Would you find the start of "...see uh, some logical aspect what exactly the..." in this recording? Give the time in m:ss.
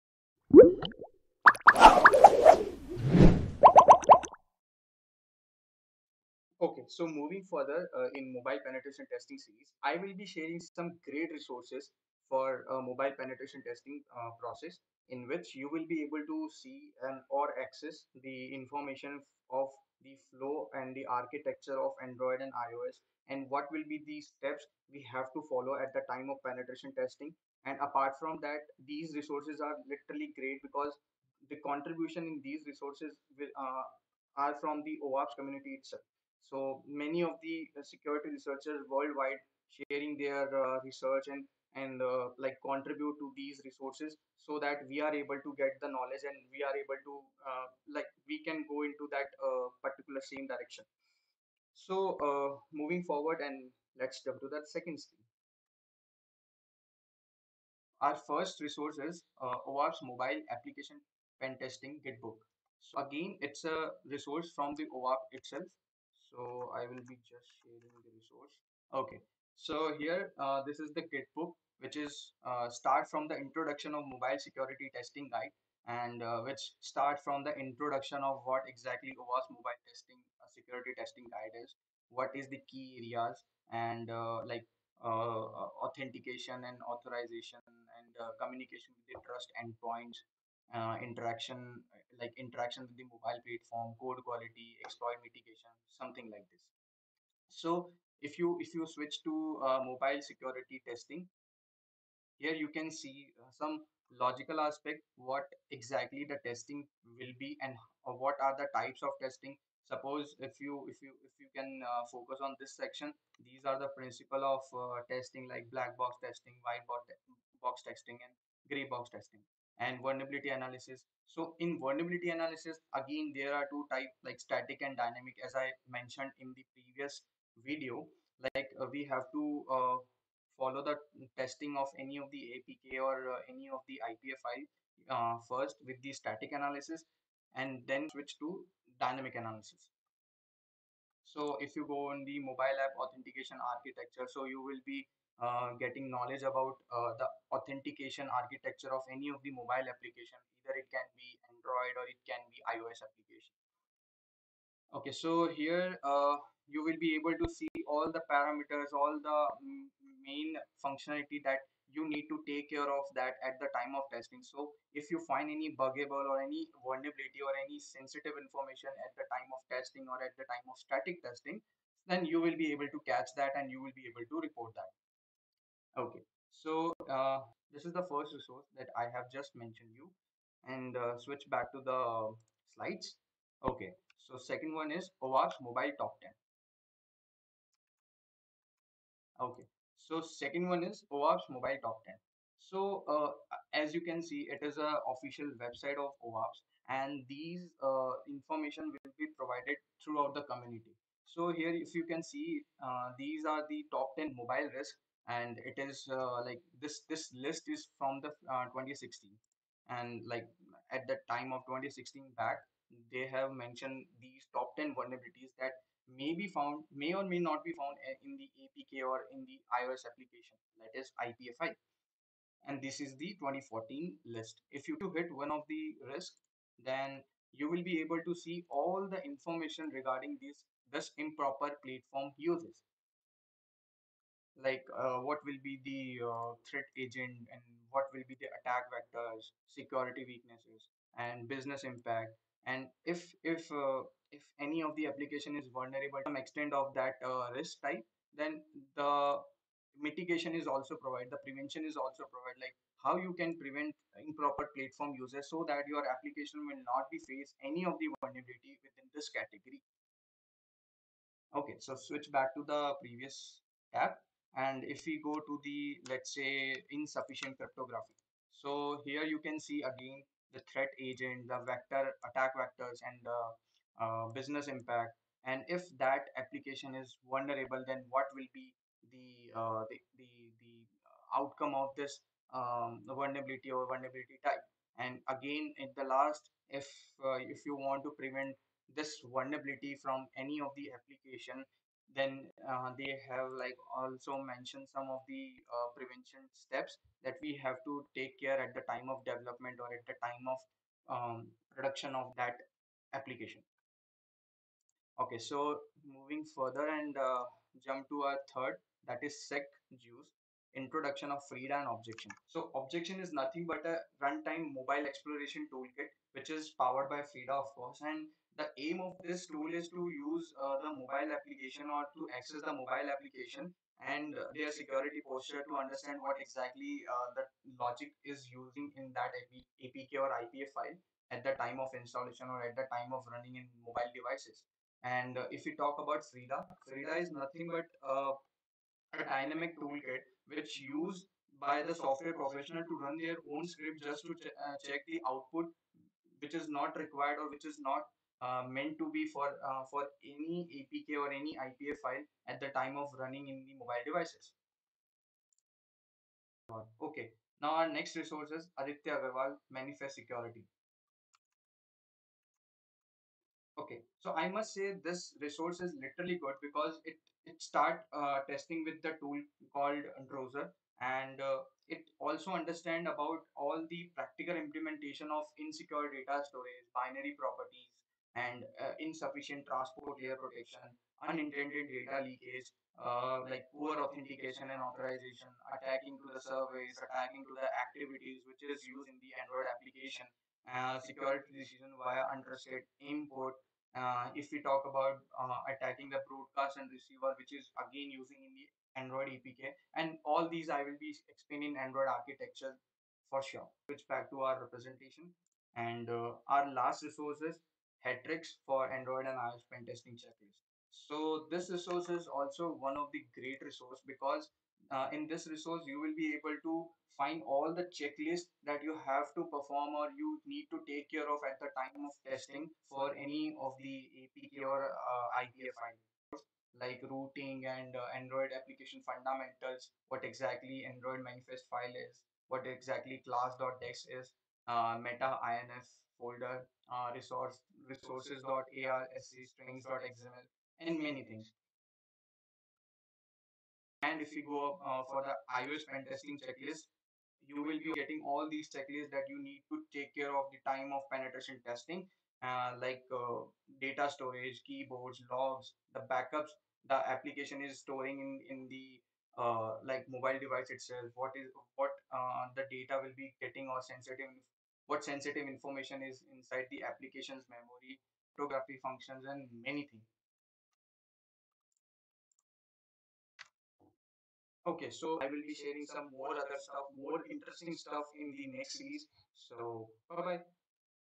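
1:42.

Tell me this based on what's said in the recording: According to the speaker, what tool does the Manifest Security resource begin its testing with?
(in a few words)
Androser.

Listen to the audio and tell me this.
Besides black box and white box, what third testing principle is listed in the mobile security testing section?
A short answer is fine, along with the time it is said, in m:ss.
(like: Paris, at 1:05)
Gray box testing, at 1:58.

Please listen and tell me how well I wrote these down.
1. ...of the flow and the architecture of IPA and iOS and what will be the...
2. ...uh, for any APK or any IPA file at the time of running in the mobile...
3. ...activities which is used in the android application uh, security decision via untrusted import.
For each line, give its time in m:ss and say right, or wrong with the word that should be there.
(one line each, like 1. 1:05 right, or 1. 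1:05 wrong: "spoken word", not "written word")
1. 0:19 wrong: "Android", not "IPA"
2. 5:49 right
3. 6:27 right.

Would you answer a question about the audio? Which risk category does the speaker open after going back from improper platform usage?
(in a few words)
Insufficient cryptography.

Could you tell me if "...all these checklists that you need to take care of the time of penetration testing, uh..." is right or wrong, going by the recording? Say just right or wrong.
right.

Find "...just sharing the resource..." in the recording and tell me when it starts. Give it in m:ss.
1:07.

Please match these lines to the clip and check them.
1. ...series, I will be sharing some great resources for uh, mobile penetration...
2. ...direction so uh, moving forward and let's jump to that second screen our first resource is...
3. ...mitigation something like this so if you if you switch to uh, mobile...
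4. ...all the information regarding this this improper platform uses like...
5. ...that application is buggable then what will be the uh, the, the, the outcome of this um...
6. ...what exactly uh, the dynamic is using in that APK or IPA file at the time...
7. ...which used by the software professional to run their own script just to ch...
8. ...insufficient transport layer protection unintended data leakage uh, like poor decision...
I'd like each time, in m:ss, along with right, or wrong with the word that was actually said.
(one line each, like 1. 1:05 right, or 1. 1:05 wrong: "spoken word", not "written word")
1. 0:09 right
2. 0:50 right
3. 1:35 right
4. 3:48 right
5. 4:35 wrong: "vulnerable", not "buggable"
6. 5:26 wrong: "logic", not "dynamic"
7. 5:40 right
8. 6:18 wrong: "authentication", not "decision".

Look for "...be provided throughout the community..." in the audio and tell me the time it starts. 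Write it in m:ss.
3:19.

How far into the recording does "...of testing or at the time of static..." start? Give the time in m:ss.
2:49.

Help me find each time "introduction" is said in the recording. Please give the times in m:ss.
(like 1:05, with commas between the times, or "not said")
1:13, 1:17, 5:10.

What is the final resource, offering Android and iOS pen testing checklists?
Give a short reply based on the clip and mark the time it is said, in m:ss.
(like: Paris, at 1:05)
HackTricks, at 6:48.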